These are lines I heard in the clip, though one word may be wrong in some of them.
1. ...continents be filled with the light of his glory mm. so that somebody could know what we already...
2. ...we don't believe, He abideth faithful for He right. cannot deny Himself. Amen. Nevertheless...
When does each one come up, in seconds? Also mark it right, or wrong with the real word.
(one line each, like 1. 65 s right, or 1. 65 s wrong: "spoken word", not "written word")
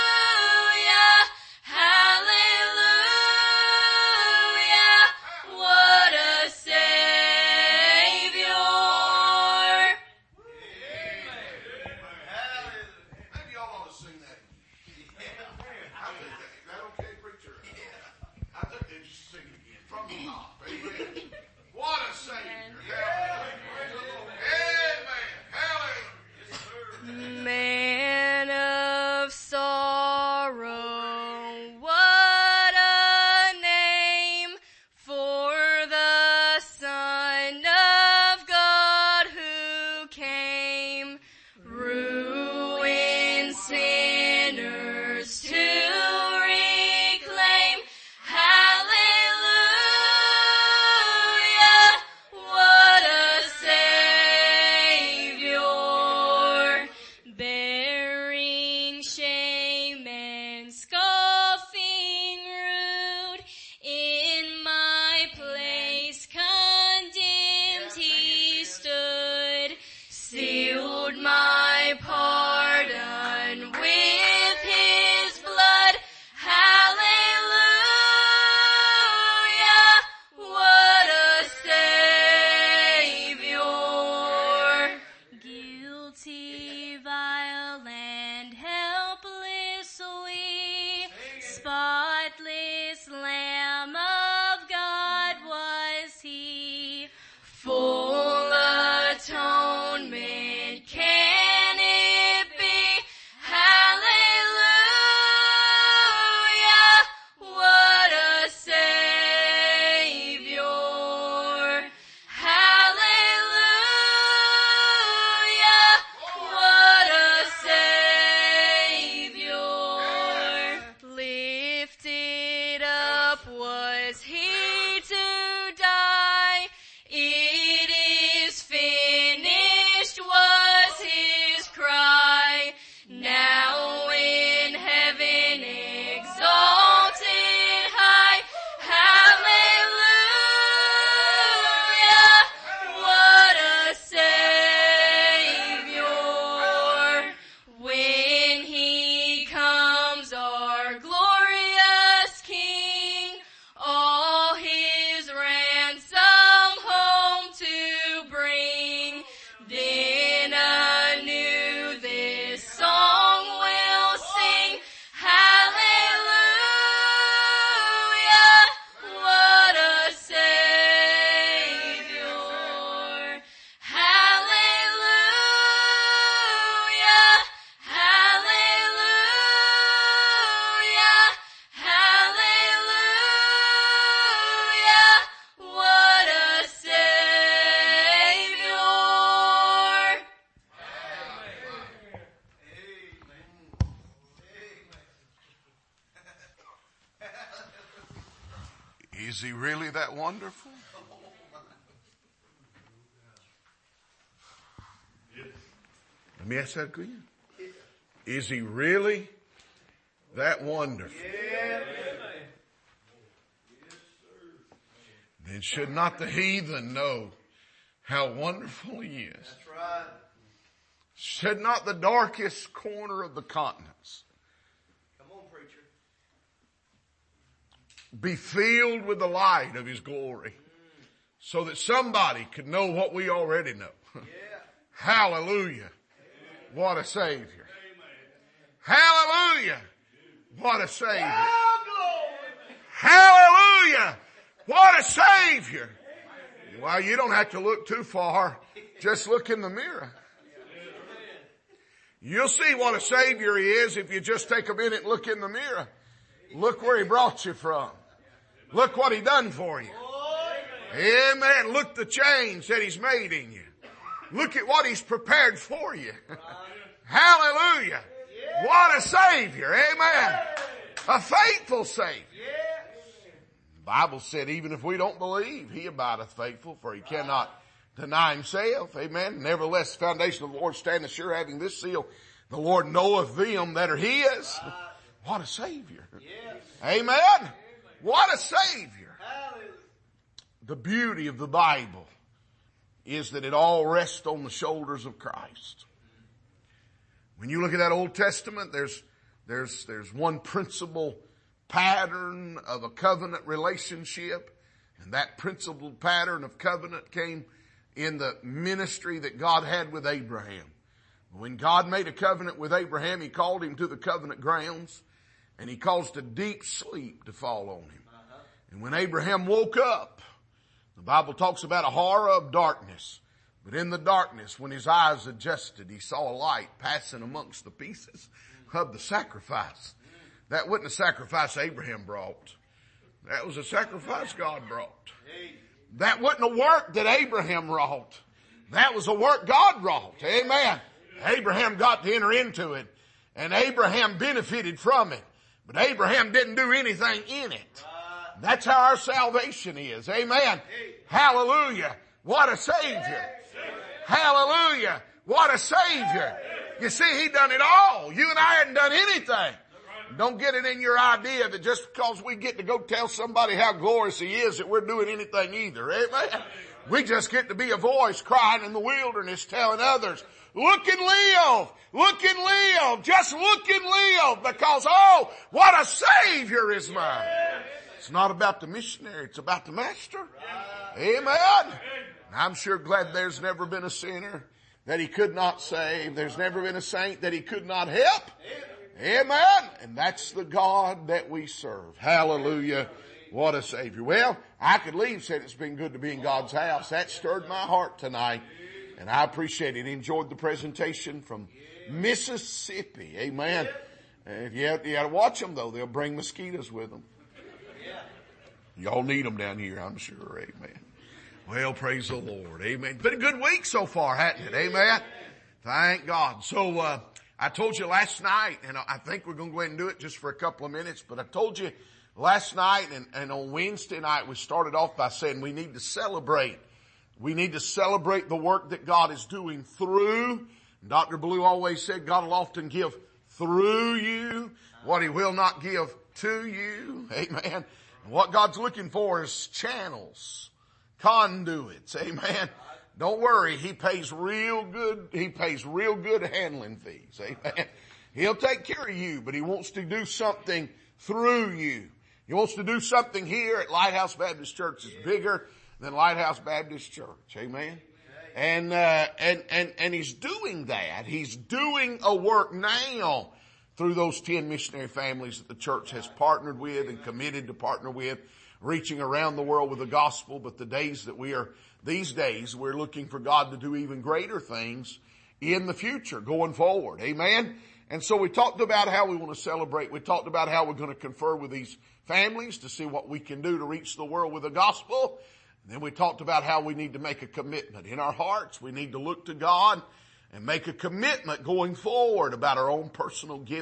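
1. 223 s right
2. 274 s right.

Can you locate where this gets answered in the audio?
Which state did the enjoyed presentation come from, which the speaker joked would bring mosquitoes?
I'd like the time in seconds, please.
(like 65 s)
401 s.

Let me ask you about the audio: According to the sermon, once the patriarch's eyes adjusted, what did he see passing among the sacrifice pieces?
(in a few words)
A light.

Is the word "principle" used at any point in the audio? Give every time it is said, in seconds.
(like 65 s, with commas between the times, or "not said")
300 s, 305 s.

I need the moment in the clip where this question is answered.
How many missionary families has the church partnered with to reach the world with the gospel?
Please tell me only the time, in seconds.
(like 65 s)
464 s.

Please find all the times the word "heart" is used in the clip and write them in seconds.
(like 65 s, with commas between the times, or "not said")
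397 s, 488 s.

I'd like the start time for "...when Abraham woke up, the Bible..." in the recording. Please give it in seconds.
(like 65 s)
318 s.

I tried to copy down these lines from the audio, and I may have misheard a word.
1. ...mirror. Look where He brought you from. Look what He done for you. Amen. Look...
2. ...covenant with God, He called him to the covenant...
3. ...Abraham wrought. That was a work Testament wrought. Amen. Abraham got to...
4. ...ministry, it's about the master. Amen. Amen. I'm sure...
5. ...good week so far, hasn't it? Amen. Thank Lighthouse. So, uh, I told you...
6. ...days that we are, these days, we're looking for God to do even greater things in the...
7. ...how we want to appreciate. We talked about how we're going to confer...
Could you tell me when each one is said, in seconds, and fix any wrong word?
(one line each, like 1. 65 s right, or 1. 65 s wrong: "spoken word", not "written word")
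1. 255 s right
2. 312 s wrong: "Abraham", not "God"
3. 337 s wrong: "God", not "Testament"
4. 378 s wrong: "missionary", not "ministry"
5. 413 s wrong: "God", not "Lighthouse"
6. 470 s right
7. 478 s wrong: "celebrate", not "appreciate".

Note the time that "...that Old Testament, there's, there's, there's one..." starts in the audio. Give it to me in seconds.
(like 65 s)
297 s.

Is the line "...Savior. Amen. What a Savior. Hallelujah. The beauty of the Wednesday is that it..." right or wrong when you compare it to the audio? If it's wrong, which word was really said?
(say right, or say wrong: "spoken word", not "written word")
wrong: "Bible", not "Wednesday".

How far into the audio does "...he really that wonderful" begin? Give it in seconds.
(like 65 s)
208 s.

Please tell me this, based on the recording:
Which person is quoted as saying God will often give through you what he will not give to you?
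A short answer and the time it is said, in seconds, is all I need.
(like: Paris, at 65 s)
Dr. Blue, at 430 s.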